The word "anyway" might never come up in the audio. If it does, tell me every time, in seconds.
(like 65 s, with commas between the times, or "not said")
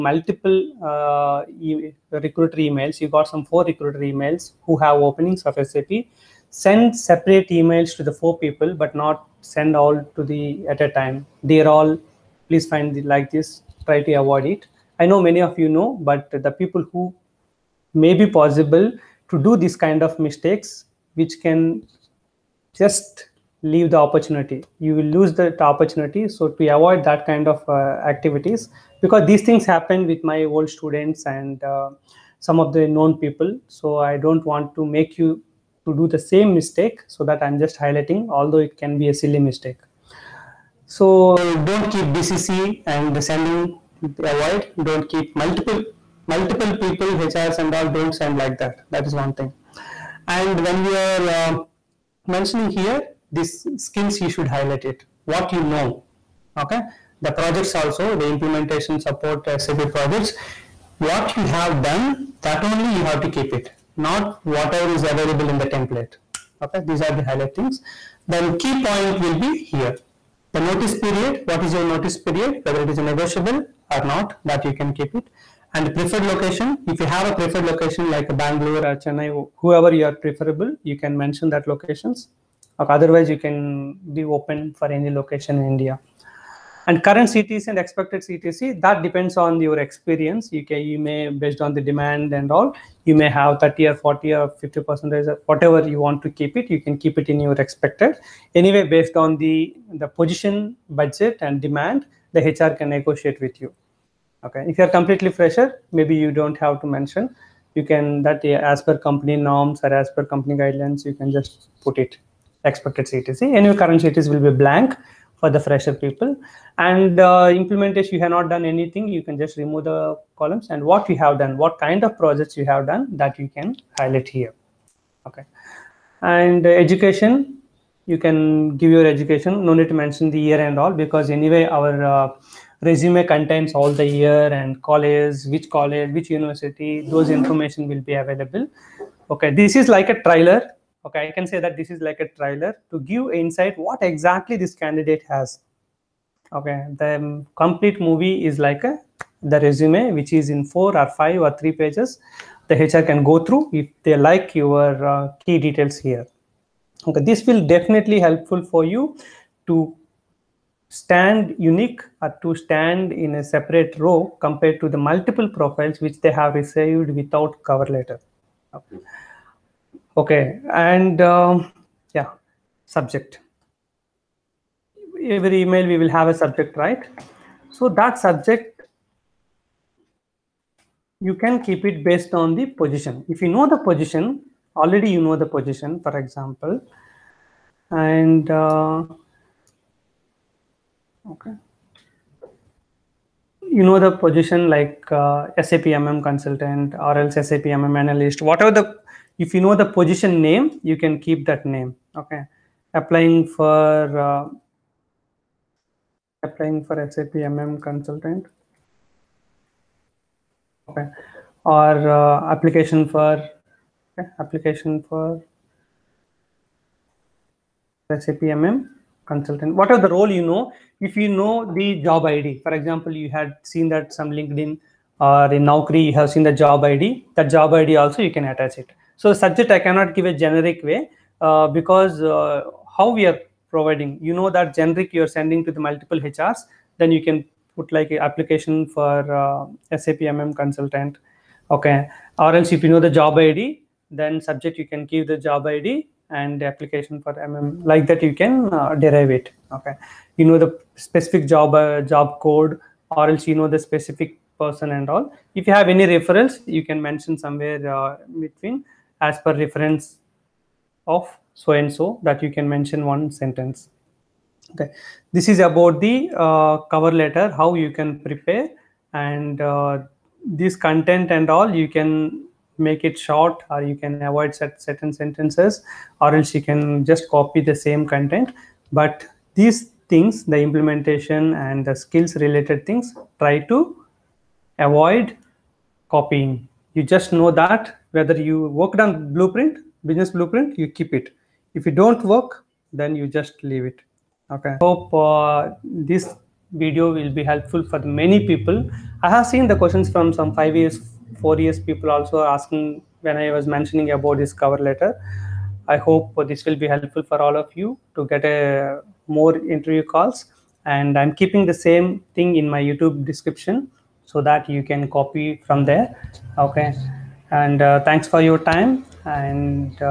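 98 s, 113 s, 131 s.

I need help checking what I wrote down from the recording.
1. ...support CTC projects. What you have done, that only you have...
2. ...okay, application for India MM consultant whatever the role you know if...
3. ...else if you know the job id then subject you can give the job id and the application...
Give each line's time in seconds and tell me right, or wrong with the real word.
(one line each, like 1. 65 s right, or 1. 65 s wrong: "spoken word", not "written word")
1. 58 s wrong: "SAP", not "CTC"
2. 214 s wrong: "SAP", not "India"
3. 242 s right.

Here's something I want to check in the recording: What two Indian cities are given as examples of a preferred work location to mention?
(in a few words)
Bangalore or Chennai.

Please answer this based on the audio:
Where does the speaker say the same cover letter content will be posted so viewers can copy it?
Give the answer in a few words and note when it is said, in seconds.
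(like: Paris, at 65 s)
YouTube description, at 312 s.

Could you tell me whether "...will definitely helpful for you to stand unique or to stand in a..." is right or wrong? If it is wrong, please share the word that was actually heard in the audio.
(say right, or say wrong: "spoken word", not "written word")
right.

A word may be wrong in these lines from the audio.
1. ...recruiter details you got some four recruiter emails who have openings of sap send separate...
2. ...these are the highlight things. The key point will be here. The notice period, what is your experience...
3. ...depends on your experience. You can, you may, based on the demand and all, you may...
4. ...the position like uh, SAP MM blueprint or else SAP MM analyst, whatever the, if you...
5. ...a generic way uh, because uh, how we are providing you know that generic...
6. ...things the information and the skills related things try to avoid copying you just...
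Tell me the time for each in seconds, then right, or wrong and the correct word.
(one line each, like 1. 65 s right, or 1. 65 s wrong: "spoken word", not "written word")
1. 2 s wrong: "emails", not "details"
2. 66 s wrong: "notice", not "experience"
3. 89 s right
4. 193 s wrong: "consultant", not "blueprint"
5. 230 s right
6. 280 s wrong: "implementation", not "information".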